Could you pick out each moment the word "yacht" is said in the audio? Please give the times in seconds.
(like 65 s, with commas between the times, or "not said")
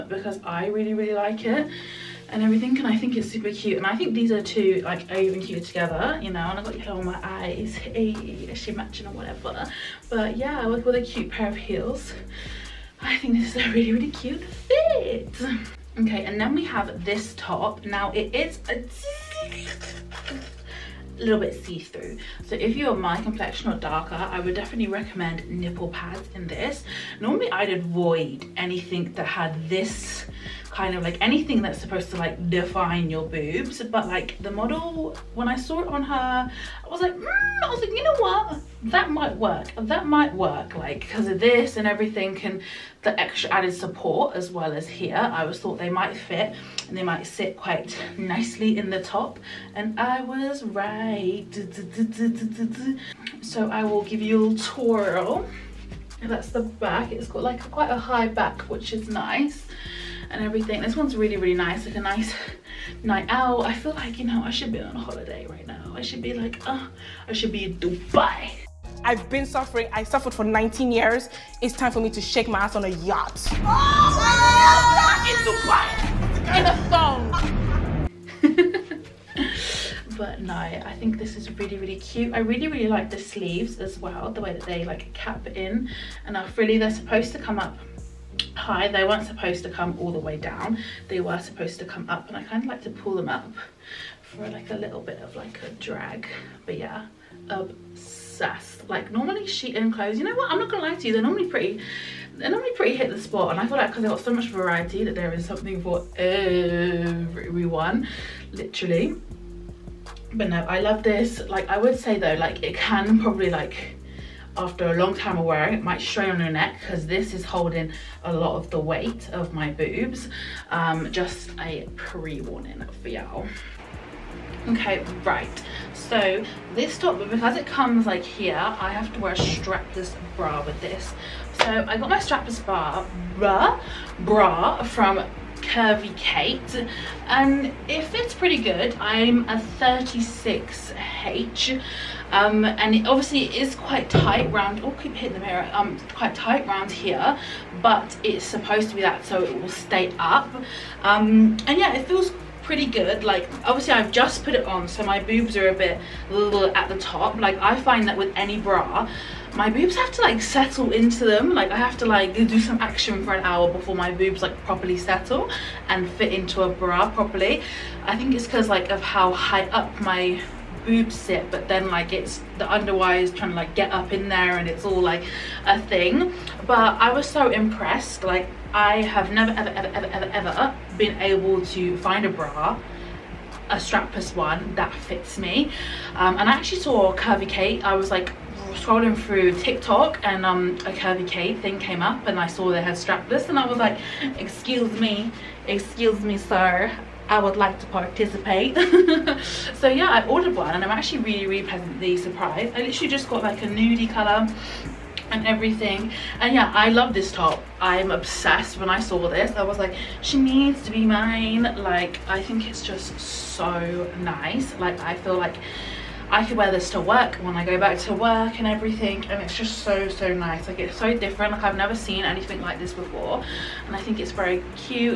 72 s.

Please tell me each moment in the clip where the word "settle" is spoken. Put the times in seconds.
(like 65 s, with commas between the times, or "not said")
160 s, 164 s.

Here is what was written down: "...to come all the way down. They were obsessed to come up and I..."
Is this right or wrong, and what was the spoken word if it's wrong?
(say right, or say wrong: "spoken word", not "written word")
wrong: "supposed", not "obsessed".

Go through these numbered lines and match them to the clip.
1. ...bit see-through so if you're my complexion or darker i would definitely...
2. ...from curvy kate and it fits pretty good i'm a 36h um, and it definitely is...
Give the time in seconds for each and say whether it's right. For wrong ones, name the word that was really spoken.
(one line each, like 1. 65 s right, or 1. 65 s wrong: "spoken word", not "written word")
1. 21 s right
2. 134 s wrong: "obviously", not "definitely".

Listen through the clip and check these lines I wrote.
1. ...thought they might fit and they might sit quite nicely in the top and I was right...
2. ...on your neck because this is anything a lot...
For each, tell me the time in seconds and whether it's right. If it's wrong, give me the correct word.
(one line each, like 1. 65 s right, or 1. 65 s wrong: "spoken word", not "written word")
1. 45 s right
2. 116 s wrong: "holding", not "anything".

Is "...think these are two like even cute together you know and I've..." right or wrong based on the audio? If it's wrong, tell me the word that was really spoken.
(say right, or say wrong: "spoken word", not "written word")
right.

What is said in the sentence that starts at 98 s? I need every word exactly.
Like normally Shein clothes, you know what?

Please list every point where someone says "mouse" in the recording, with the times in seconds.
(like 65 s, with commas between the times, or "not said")
not said.